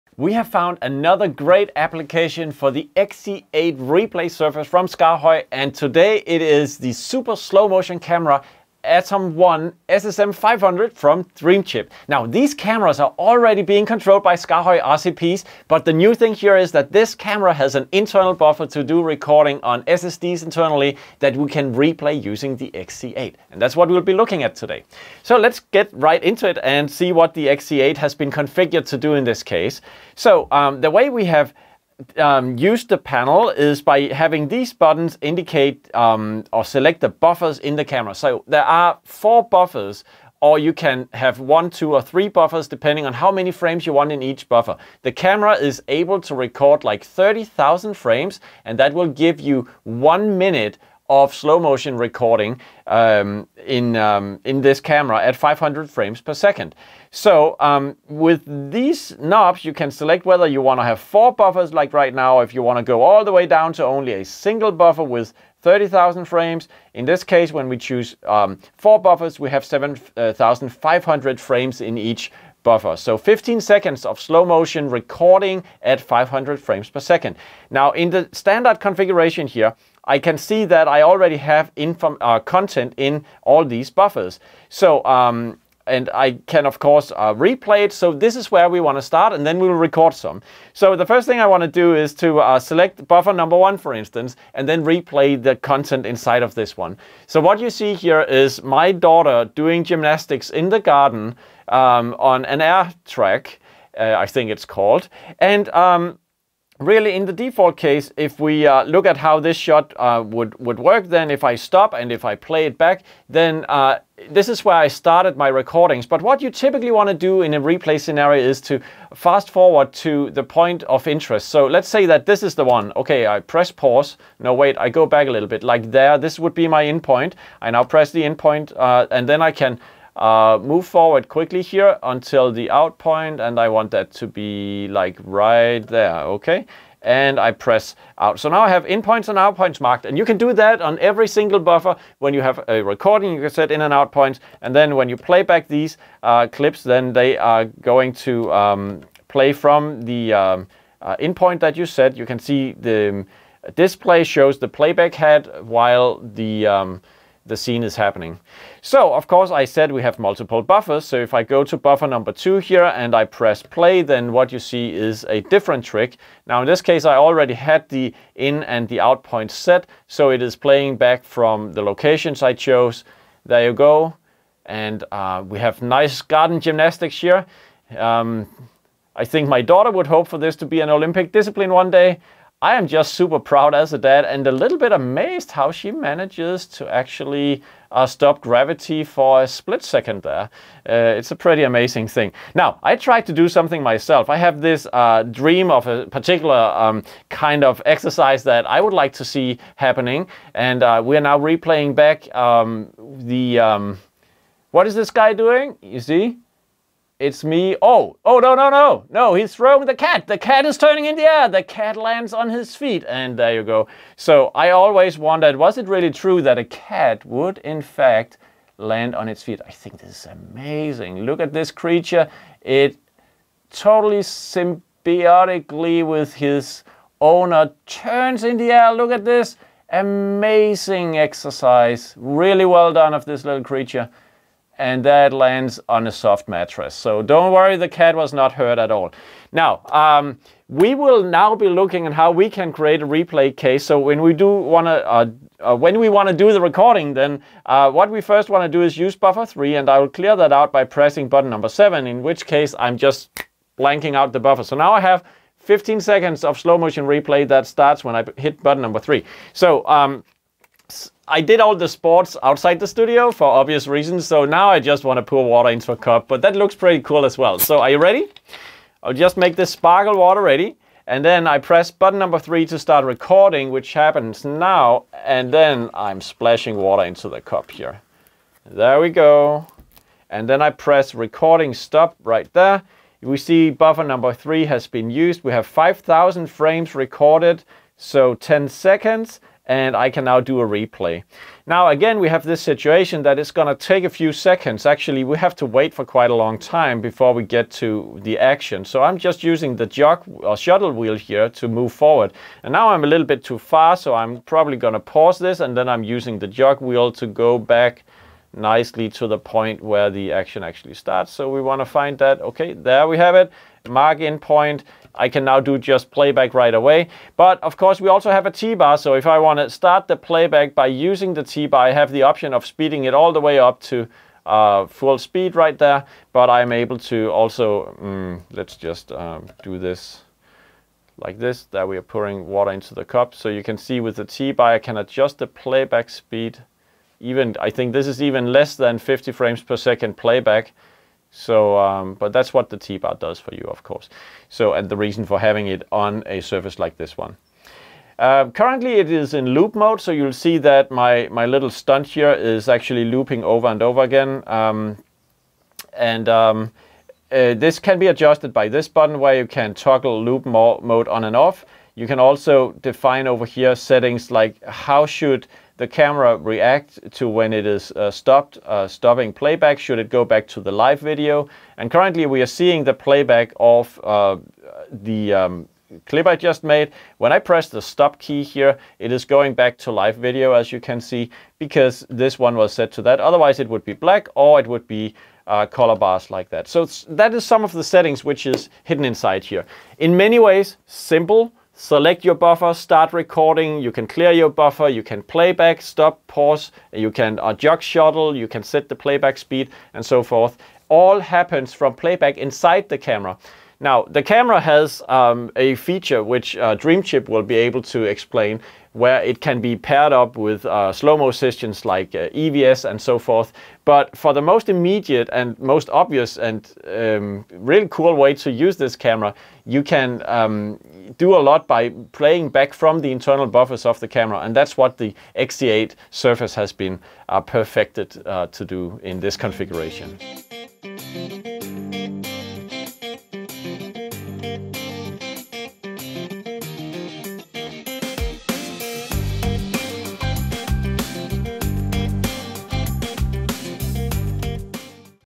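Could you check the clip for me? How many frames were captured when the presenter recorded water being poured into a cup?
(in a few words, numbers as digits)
5,000.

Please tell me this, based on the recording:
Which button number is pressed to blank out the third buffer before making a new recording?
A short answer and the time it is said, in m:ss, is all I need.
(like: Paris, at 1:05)
7, at 4:11.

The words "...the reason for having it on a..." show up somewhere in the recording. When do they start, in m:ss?
5:44.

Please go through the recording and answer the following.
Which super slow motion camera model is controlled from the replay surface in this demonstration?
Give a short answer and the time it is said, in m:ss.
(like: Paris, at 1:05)
Atom 1 SSM500, at 0:08.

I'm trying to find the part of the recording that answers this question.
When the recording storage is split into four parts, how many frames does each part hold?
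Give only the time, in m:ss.
1:09.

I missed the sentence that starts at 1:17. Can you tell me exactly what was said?
Now in the standard configuration here, I can see that I already have uh, content in all these buffers.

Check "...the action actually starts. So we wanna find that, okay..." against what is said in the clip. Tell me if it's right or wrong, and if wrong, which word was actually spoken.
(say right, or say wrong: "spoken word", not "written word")
right.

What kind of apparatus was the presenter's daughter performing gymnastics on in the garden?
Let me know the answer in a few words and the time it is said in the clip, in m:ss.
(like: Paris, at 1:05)
air track, at 1:42.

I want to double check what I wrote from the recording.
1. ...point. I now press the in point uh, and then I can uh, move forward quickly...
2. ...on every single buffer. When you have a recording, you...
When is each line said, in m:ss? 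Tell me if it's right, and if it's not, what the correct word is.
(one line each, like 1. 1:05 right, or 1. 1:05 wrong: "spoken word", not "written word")
1. 2:06 right
2. 2:20 right.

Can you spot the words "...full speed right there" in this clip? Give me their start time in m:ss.
5:24.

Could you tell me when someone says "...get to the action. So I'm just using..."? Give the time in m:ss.
4:57.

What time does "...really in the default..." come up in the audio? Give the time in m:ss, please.
1:46.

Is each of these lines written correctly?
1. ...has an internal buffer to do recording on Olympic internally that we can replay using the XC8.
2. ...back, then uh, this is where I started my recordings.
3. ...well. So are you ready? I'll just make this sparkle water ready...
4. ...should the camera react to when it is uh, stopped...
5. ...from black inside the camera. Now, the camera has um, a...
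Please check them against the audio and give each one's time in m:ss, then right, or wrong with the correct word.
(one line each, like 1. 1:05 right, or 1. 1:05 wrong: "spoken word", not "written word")
1. 0:17 wrong: "SSDs", not "Olympic"
2. 1:52 right
3. 4:27 right
4. 6:05 right
5. 6:41 wrong: "playback", not "black".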